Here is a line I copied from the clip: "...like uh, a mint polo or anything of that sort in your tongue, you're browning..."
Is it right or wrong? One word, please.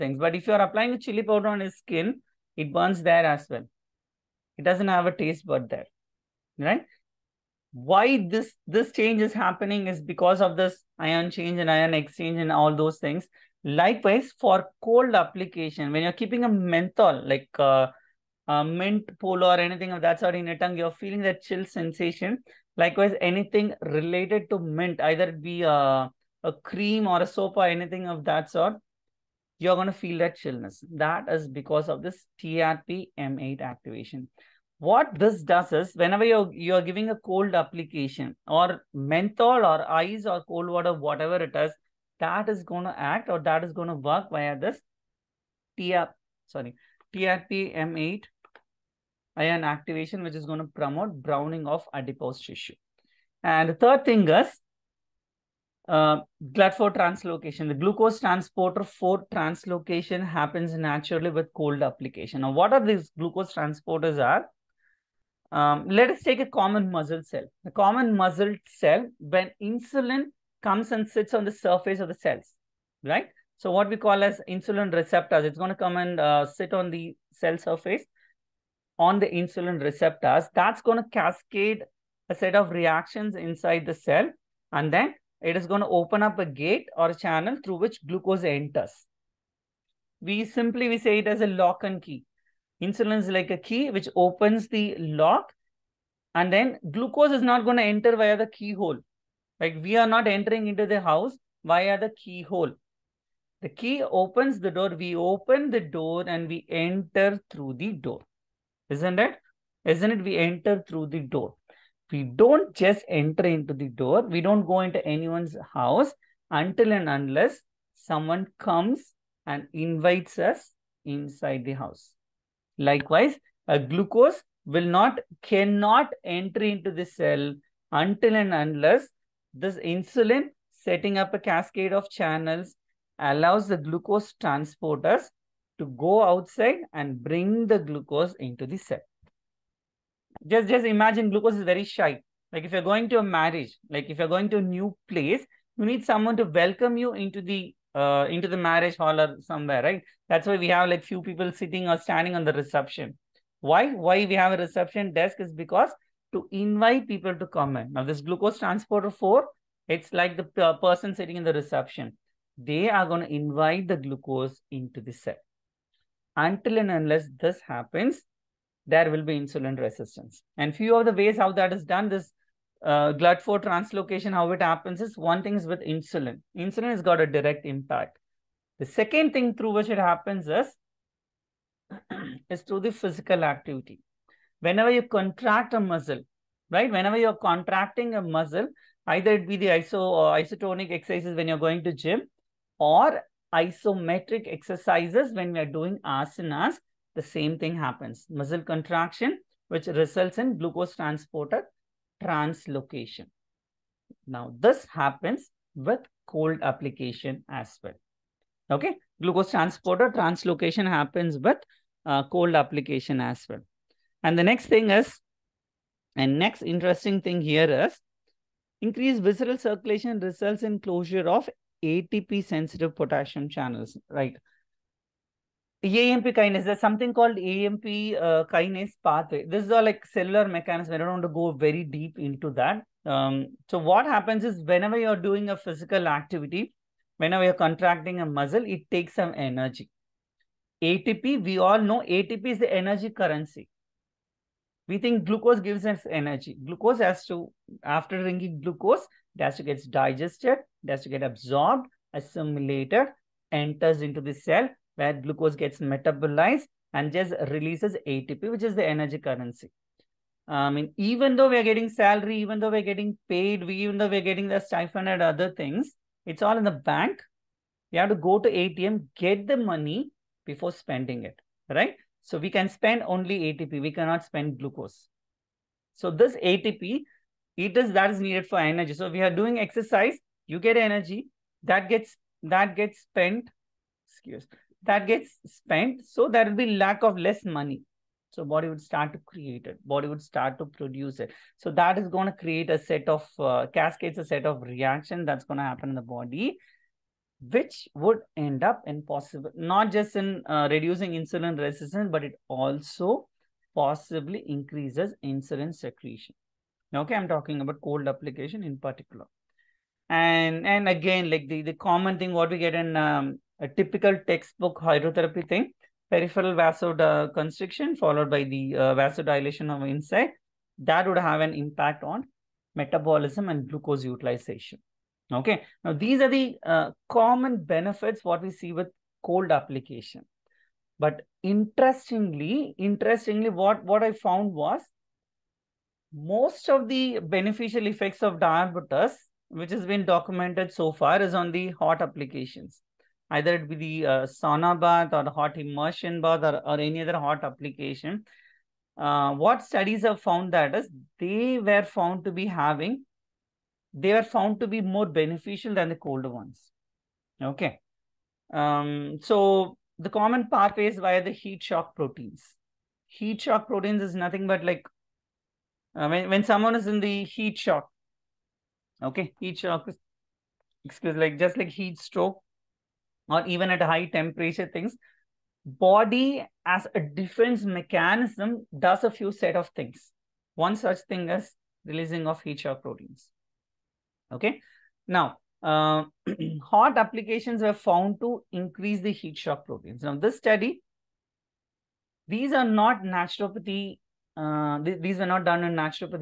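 wrong.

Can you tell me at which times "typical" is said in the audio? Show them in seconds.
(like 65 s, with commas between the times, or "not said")
313 s.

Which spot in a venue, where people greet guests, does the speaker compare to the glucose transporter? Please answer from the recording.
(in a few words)
reception desk.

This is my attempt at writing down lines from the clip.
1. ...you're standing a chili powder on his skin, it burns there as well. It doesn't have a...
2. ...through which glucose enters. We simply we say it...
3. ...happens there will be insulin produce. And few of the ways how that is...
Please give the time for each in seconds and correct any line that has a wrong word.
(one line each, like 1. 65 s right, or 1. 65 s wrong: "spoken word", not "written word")
1. 0 s wrong: "applying", not "standing"
2. 87 s right
3. 167 s wrong: "resistance", not "produce".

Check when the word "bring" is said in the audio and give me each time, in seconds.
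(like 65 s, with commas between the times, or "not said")
137 s.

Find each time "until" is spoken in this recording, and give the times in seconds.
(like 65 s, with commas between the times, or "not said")
116 s, 128 s, 166 s.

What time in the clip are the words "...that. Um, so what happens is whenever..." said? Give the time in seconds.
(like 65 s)
232 s.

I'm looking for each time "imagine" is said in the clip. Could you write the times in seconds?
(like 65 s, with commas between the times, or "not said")
140 s.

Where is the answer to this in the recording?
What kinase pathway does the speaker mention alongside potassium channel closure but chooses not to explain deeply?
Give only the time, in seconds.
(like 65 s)
225 s.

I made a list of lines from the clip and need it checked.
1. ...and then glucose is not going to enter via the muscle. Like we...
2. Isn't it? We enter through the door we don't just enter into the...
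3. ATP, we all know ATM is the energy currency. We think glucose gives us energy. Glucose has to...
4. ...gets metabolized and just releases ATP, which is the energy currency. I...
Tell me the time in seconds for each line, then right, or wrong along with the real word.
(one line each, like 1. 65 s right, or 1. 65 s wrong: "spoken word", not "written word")
1. 96 s wrong: "keyhole", not "muscle"
2. 109 s right
3. 240 s wrong: "ATP", not "ATM"
4. 255 s right.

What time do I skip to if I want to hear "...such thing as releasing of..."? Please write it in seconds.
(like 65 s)
380 s.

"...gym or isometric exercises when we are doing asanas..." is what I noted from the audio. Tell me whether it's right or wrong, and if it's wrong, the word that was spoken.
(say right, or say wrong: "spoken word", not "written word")
right.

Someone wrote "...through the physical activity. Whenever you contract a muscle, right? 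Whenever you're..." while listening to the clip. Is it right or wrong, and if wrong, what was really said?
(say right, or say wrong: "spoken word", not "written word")
right.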